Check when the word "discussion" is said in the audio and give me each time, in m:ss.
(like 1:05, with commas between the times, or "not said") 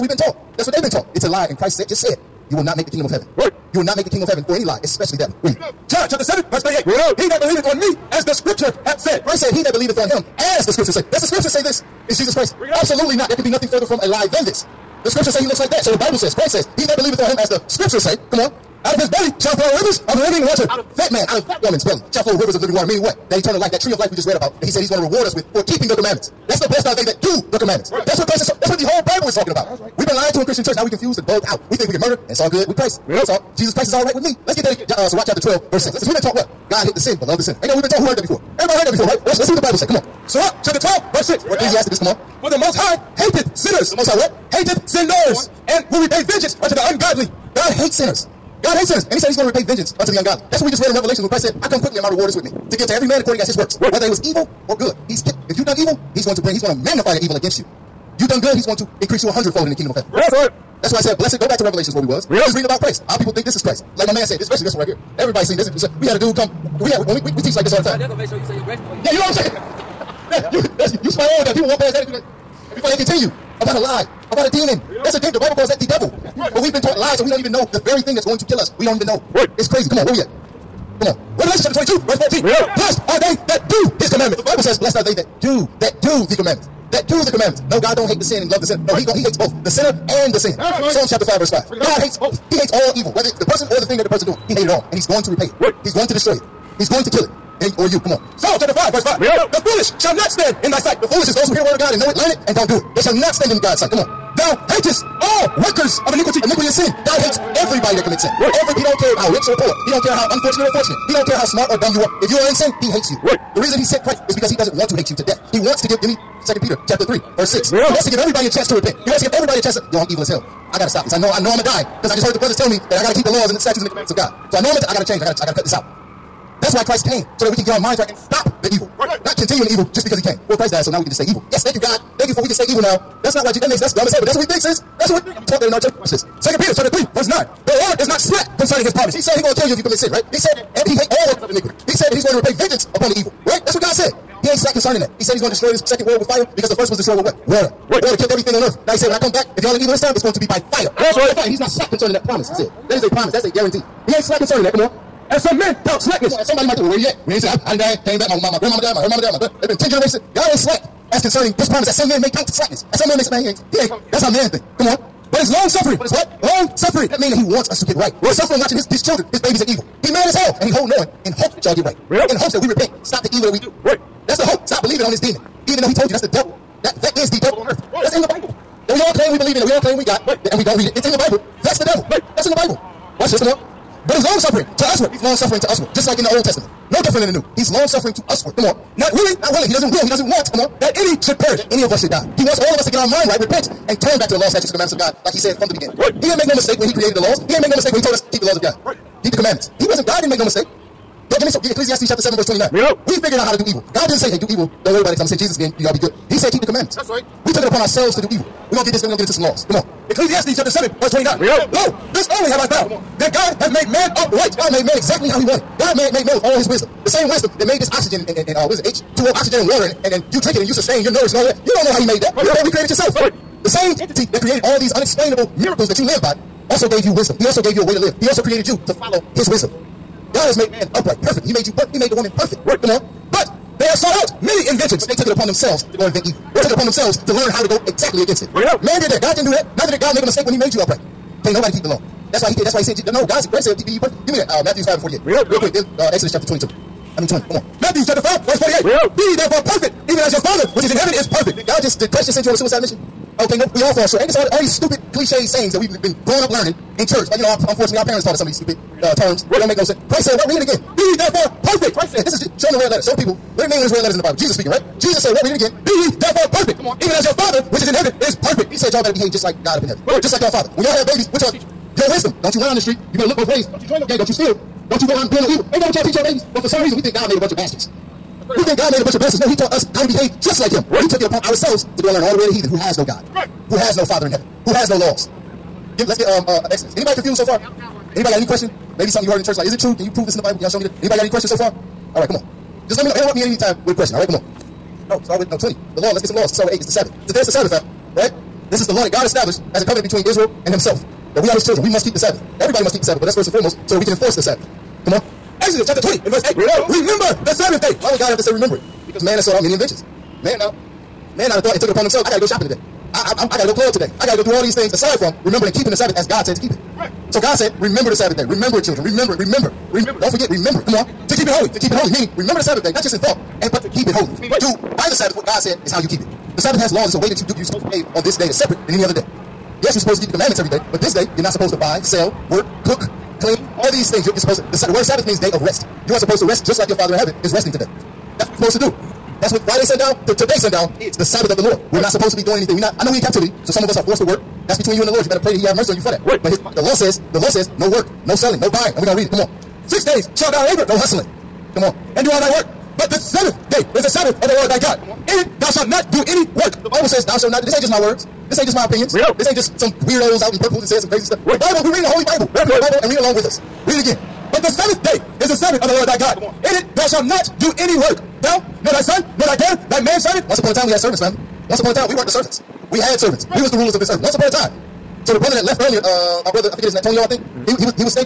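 not said.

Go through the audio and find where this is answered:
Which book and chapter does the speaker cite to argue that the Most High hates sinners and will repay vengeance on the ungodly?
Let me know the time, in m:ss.
0:40.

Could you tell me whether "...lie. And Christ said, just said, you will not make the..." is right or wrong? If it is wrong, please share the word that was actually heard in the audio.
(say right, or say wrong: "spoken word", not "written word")
right.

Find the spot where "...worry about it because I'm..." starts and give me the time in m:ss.
3:24.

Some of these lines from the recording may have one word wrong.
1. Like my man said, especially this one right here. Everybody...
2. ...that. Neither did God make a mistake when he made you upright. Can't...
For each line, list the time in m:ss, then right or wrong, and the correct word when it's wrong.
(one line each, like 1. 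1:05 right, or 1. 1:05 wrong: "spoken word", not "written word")
1. 1:03 right
2. 3:59 right.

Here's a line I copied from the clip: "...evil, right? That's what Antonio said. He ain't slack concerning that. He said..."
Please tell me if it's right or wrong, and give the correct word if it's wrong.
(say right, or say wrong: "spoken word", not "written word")
wrong: "God", not "Antonio".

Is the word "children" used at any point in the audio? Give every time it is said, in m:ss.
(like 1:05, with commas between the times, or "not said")
2:49, 5:01, 5:18.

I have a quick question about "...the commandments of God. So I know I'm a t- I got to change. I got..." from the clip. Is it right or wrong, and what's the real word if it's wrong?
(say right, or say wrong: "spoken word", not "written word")
right.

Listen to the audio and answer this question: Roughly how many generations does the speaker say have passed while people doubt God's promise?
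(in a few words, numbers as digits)
10.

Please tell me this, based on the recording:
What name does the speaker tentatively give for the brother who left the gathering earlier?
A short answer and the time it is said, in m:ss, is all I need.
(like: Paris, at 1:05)
Antonio, at 6:17.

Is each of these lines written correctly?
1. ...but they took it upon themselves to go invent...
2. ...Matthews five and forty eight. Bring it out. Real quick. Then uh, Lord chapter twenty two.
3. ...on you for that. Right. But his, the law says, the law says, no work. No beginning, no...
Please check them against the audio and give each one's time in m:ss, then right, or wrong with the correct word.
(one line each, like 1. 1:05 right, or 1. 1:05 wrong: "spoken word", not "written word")
1. 3:55 right
2. 4:04 wrong: "Exodus", not "Lord"
3. 5:45 wrong: "selling", not "beginning".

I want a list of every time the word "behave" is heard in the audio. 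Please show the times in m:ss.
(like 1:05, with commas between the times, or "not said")
4:29, 4:40, 5:27.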